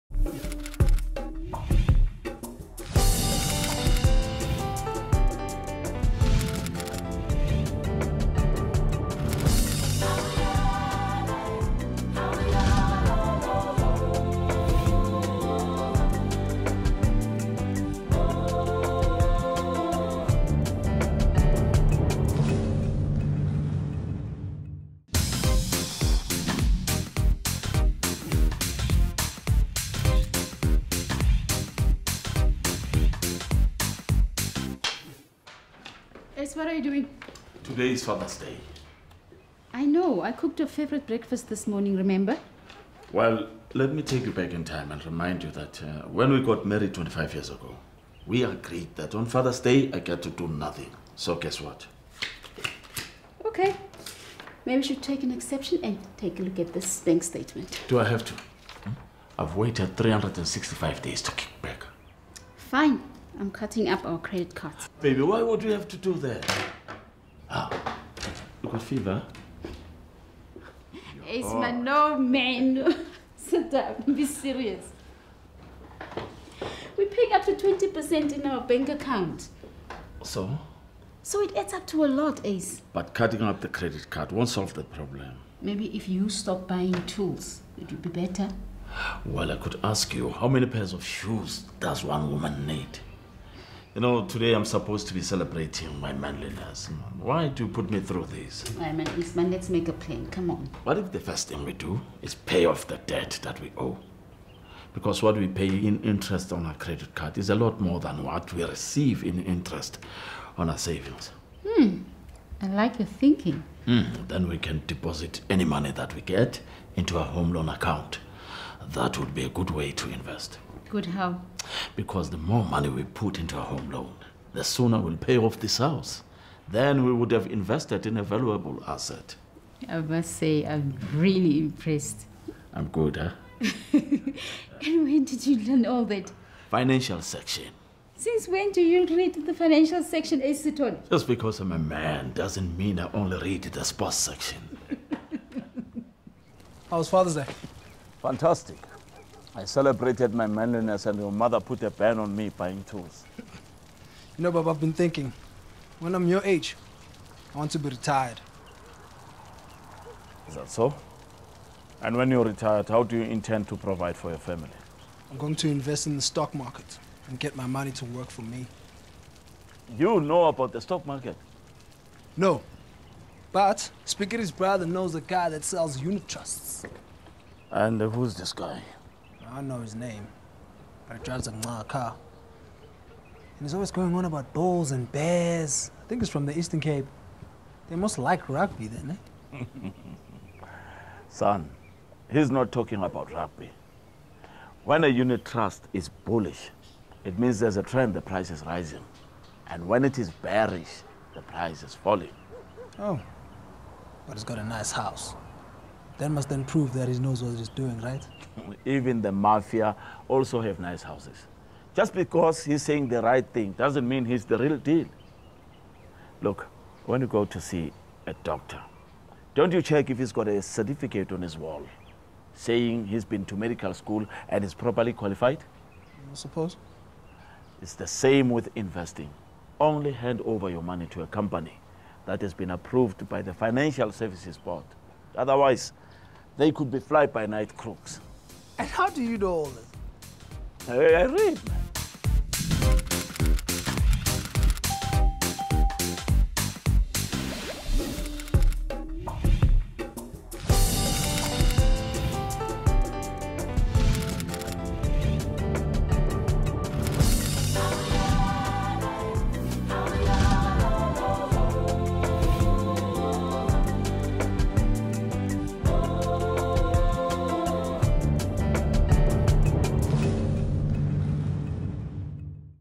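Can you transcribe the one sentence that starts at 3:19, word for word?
And when it is bearish, the price is falling.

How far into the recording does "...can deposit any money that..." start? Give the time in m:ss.
1:54.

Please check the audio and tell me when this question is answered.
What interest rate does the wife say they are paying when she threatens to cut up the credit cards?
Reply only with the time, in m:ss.
1:17.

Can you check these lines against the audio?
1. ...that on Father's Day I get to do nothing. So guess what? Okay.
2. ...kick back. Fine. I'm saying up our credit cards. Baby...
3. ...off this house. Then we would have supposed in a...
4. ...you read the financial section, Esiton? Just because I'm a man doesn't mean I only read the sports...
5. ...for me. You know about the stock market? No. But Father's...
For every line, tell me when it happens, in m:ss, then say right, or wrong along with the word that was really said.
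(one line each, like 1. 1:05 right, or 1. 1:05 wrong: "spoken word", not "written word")
1. 0:48 right
2. 1:01 wrong: "cutting", not "saying"
3. 2:05 wrong: "invested", not "supposed"
4. 2:18 right
5. 2:48 wrong: "Spickery", not "Father".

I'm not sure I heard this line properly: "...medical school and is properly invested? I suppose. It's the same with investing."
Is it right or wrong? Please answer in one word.
wrong.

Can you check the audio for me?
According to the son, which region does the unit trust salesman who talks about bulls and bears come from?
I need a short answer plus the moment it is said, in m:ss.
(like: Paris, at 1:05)
Eastern Cape, at 3:06.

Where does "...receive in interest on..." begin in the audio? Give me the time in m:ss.
1:48.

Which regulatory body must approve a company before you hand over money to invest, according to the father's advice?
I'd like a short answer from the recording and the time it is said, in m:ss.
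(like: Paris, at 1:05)
Financial Services Board, at 3:53.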